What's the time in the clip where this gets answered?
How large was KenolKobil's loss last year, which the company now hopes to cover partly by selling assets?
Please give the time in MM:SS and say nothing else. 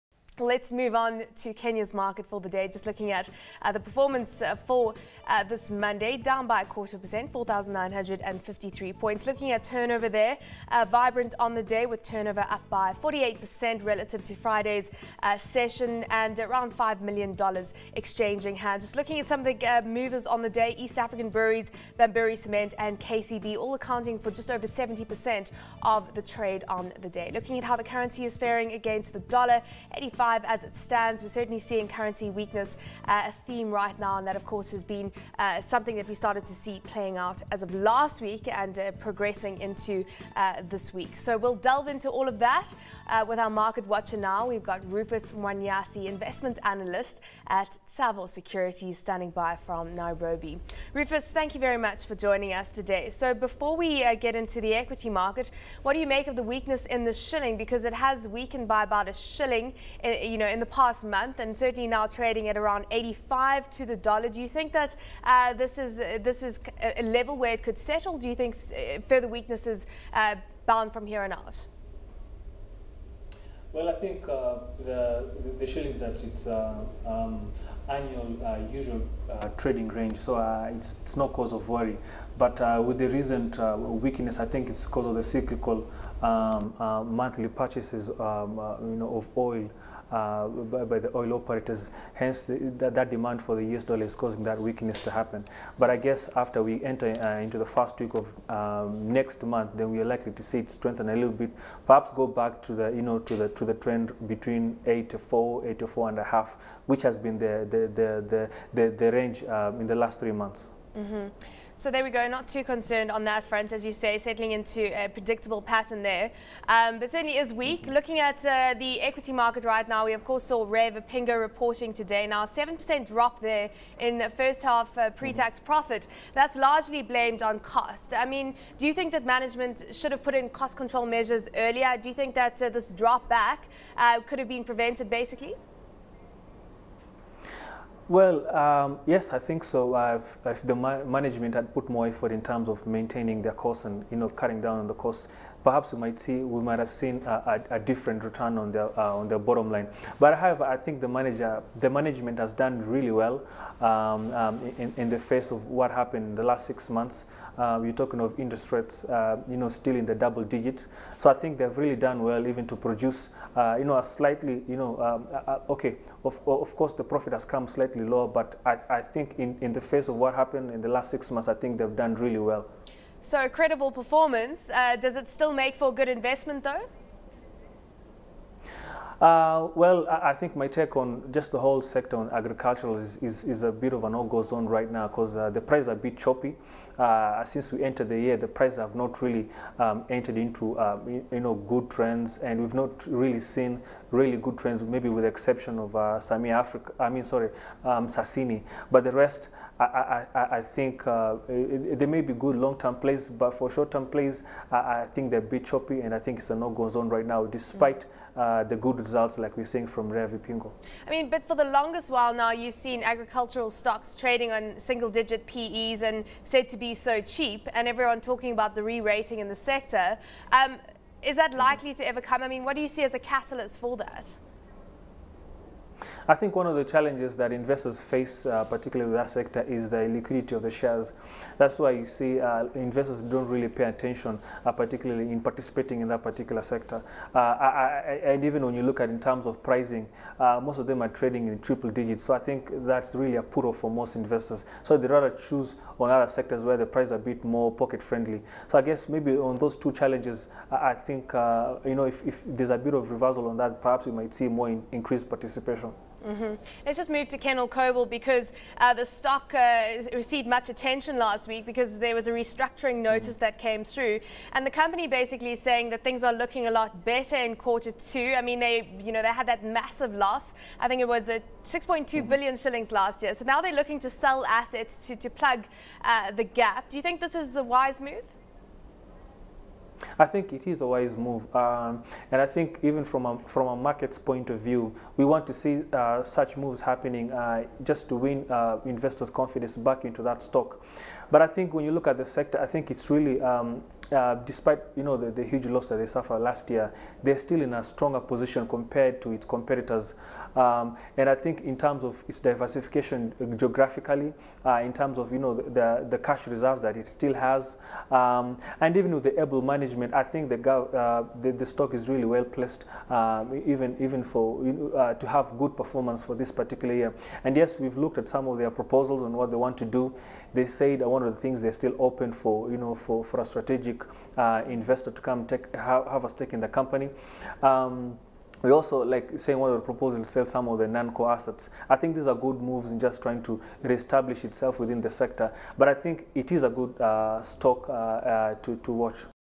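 04:31.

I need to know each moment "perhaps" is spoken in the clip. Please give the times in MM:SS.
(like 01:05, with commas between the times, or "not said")
01:41, 02:25, 04:13.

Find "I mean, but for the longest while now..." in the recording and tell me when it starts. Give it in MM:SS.
03:31.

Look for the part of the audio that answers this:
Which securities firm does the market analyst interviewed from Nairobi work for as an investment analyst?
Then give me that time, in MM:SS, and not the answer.
00:47.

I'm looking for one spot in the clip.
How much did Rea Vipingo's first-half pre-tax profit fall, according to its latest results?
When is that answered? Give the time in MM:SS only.
02:02.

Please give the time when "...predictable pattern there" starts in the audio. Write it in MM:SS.
01:55.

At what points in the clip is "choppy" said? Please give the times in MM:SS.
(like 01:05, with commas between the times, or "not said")
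03:06, 03:25.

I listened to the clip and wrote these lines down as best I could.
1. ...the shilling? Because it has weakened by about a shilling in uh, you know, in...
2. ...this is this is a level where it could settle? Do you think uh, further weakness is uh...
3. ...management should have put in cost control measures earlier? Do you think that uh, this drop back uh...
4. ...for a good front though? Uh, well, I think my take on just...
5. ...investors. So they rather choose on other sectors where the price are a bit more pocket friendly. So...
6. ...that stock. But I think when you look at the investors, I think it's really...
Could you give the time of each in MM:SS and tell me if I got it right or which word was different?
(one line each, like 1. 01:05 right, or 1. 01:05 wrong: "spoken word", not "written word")
1. 00:57 right
2. 01:05 right
3. 02:09 right
4. 02:55 wrong: "investment", not "front"
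5. 04:04 right
6. 04:50 wrong: "sector", not "investors".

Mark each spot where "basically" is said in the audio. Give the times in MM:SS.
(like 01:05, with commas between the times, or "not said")
02:15, 04:25.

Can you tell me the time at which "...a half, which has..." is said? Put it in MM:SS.
01:46.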